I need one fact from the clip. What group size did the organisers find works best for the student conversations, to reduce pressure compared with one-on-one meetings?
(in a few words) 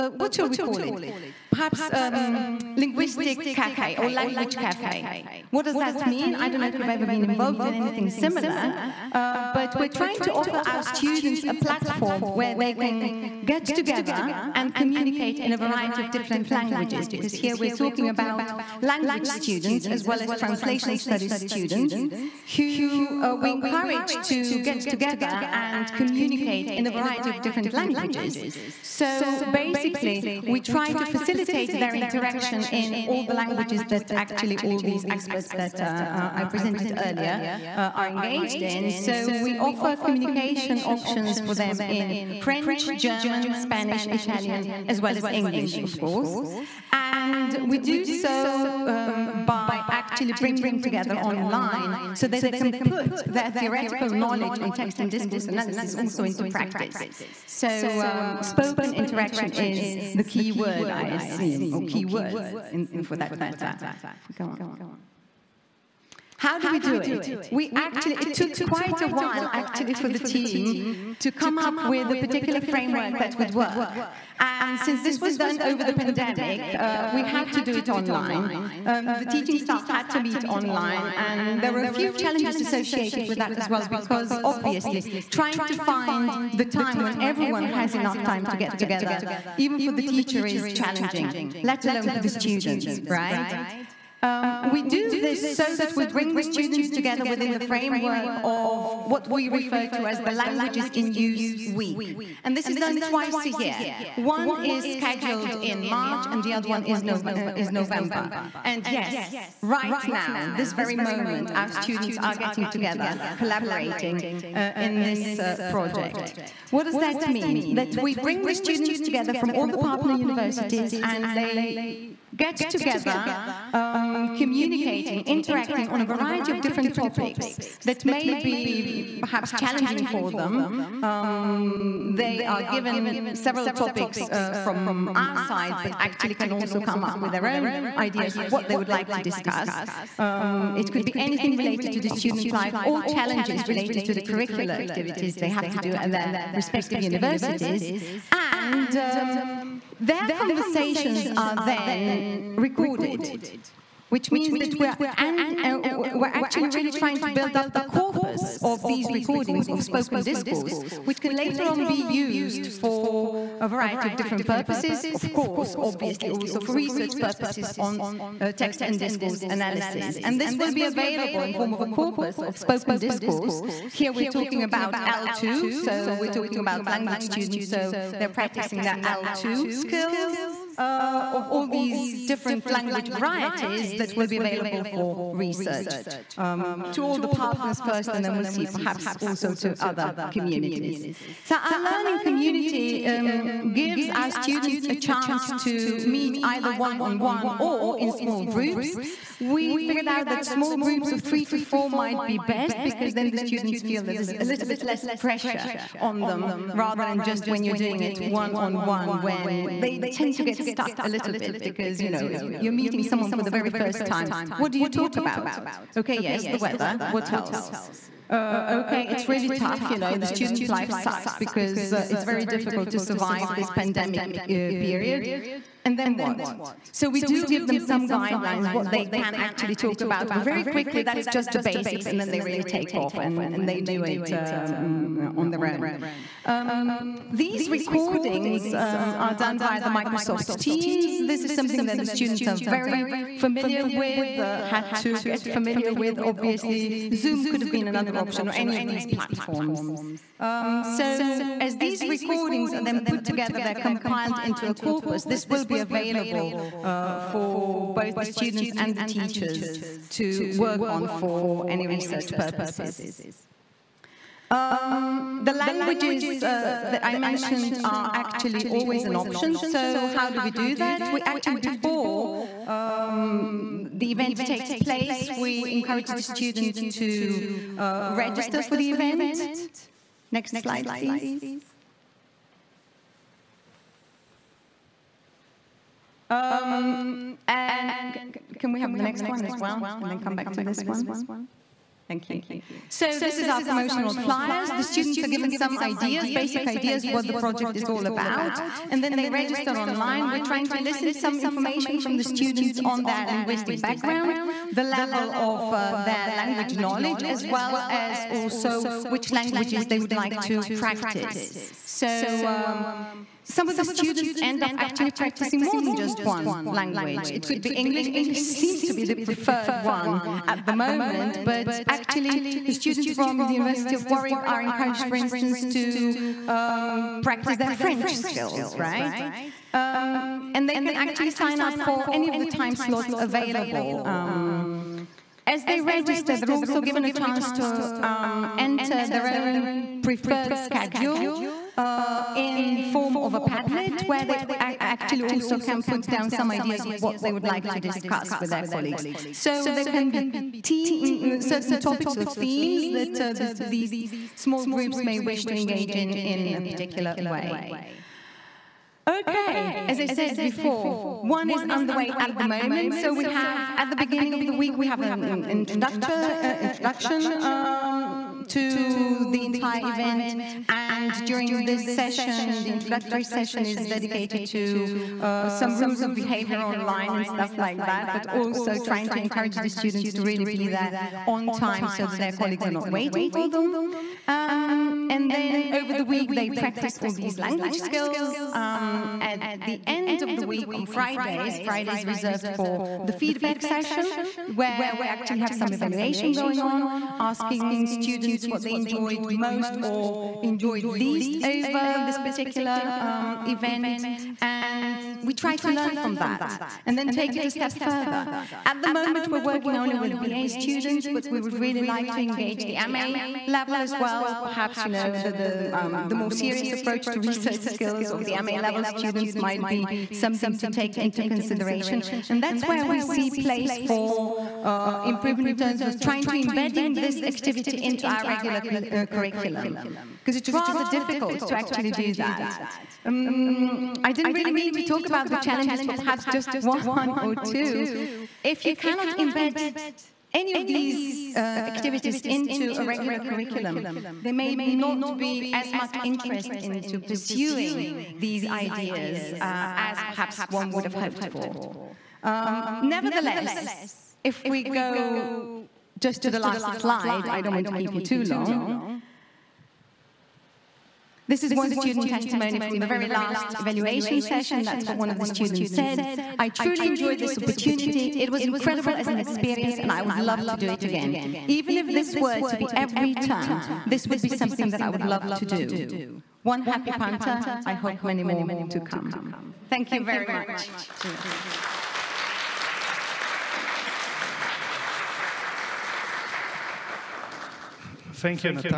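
3 to 4.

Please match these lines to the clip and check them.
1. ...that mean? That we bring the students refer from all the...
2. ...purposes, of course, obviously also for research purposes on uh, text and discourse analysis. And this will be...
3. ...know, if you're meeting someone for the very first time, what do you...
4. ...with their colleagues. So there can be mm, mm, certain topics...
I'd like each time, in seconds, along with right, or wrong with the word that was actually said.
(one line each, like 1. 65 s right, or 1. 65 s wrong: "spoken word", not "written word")
1. 116 s wrong: "together", not "refer"
2. 164 s right
3. 212 s right
4. 348 s right.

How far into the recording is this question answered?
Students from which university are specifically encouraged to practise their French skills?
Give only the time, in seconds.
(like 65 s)
323 s.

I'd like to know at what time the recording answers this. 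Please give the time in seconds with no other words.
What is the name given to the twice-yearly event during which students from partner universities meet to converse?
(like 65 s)
100 s.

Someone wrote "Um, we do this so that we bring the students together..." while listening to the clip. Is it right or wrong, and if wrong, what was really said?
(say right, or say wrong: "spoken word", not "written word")
right.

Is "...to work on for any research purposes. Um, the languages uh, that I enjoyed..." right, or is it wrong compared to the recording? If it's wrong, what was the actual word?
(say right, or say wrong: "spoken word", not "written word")
wrong: "mentioned", not "enjoyed".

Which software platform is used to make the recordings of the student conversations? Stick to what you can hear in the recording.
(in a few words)
Microsoft Teams.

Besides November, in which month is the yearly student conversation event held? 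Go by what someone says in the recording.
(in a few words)
March.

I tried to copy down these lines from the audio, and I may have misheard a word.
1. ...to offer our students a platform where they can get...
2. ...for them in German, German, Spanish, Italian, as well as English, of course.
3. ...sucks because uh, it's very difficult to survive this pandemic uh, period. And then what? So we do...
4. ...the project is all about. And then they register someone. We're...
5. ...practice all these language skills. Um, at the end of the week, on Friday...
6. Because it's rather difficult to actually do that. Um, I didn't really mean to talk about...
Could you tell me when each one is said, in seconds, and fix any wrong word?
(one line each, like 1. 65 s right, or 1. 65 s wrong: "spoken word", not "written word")
1. 10 s right
2. 41 s wrong: "French", not "German"
3. 220 s right
4. 297 s wrong: "online", not "someone"
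5. 386 s right
6. 430 s right.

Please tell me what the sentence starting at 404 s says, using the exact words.
And we try to learn from that and then take it a step further.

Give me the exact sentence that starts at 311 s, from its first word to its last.
So um, some of the students end up actually practicing more than just one language.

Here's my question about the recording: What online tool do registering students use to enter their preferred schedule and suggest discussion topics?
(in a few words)
Padlet.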